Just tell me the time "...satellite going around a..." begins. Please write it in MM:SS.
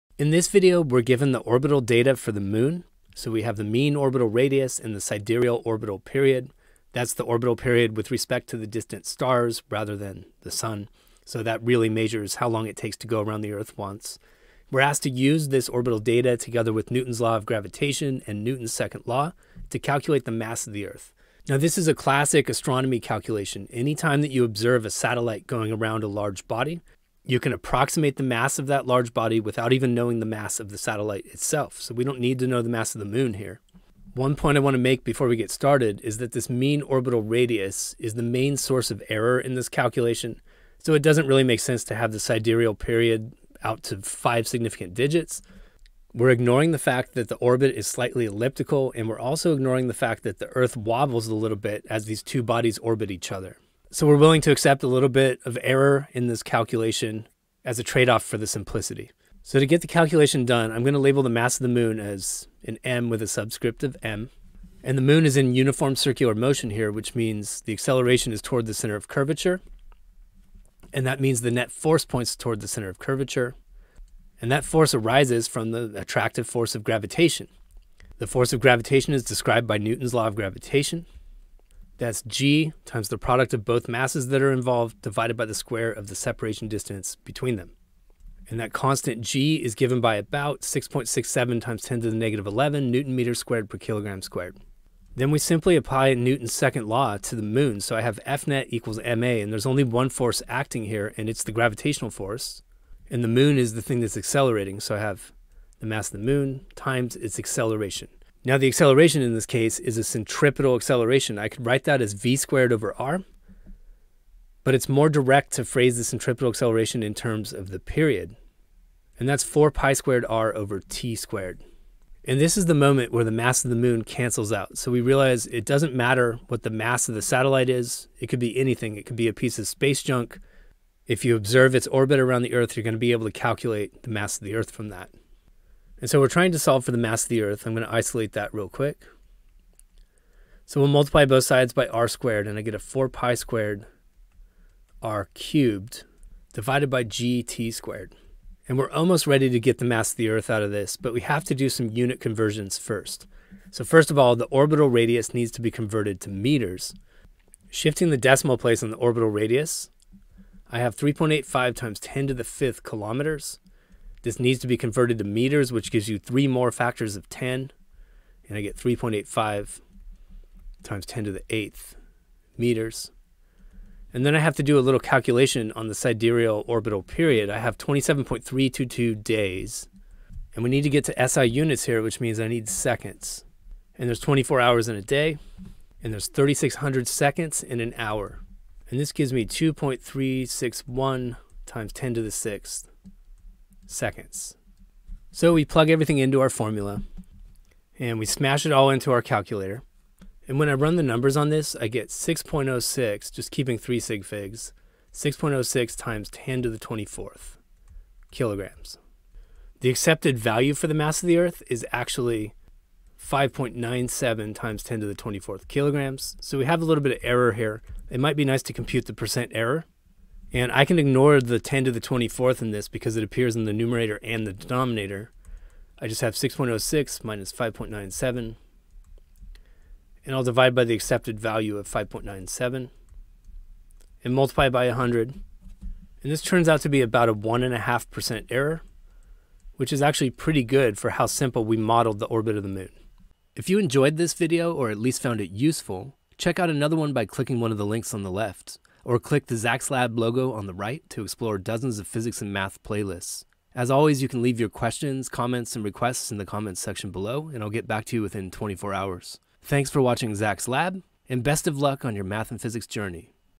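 00:24.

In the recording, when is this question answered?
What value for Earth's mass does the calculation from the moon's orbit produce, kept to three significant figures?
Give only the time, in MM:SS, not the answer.
03:25.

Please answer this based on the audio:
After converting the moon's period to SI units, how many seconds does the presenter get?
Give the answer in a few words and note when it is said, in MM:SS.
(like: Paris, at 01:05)
2.361 × 10^6 seconds, at 03:09.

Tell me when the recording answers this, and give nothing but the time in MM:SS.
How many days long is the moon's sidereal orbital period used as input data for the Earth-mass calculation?
02:57.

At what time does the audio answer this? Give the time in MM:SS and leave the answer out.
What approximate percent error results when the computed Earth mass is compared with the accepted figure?
03:57.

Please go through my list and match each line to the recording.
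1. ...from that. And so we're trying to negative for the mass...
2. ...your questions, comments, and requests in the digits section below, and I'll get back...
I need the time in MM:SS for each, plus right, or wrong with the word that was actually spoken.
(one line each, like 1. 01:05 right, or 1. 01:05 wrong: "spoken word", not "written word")
1. 02:14 wrong: "solve", not "negative"
2. 04:14 wrong: "comments", not "digits".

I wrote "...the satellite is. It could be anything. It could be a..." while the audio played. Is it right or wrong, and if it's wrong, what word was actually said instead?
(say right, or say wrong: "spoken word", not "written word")
right.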